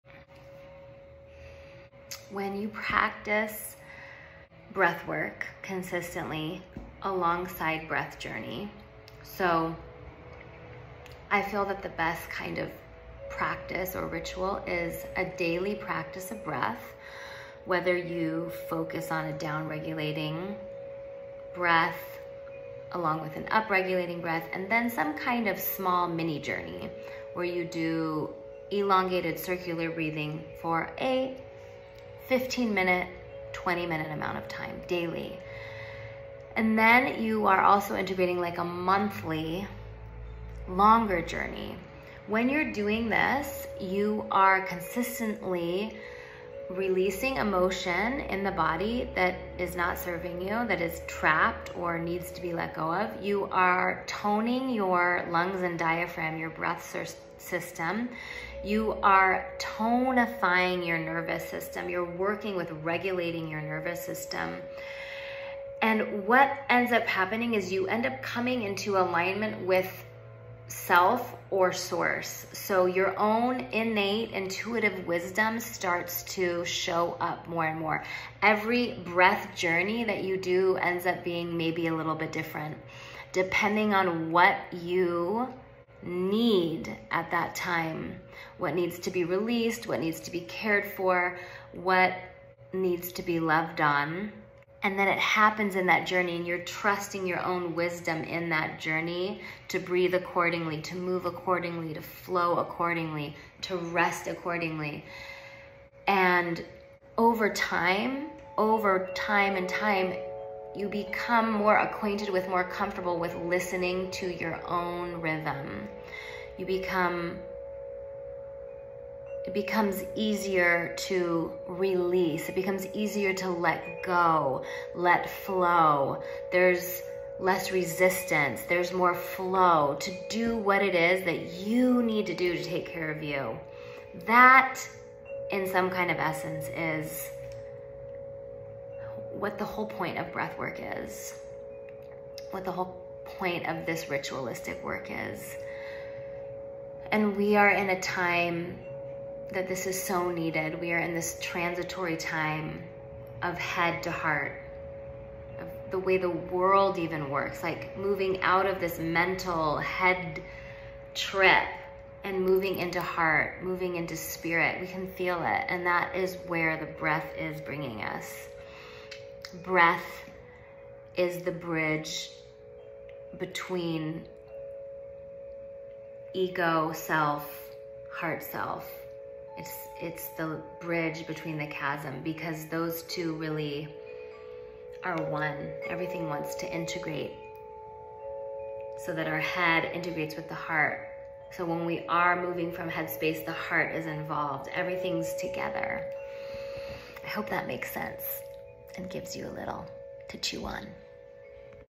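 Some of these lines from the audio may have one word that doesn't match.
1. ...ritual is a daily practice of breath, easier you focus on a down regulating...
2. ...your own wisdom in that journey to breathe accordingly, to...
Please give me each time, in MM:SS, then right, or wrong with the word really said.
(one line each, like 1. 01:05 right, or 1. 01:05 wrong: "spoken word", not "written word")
1. 00:14 wrong: "whether", not "easier"
2. 01:37 right.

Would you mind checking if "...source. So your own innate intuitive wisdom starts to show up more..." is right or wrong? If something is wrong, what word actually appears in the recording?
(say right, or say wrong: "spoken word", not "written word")
right.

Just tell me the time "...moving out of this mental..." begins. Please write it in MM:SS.
02:37.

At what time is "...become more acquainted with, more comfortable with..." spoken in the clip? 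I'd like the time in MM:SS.
01:50.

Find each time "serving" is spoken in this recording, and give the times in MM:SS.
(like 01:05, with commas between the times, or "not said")
00:49.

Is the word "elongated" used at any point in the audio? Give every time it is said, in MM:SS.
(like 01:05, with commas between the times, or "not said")
00:28.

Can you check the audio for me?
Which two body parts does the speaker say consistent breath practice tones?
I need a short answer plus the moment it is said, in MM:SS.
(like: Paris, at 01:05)
Lungs and diaphragm, at 00:55.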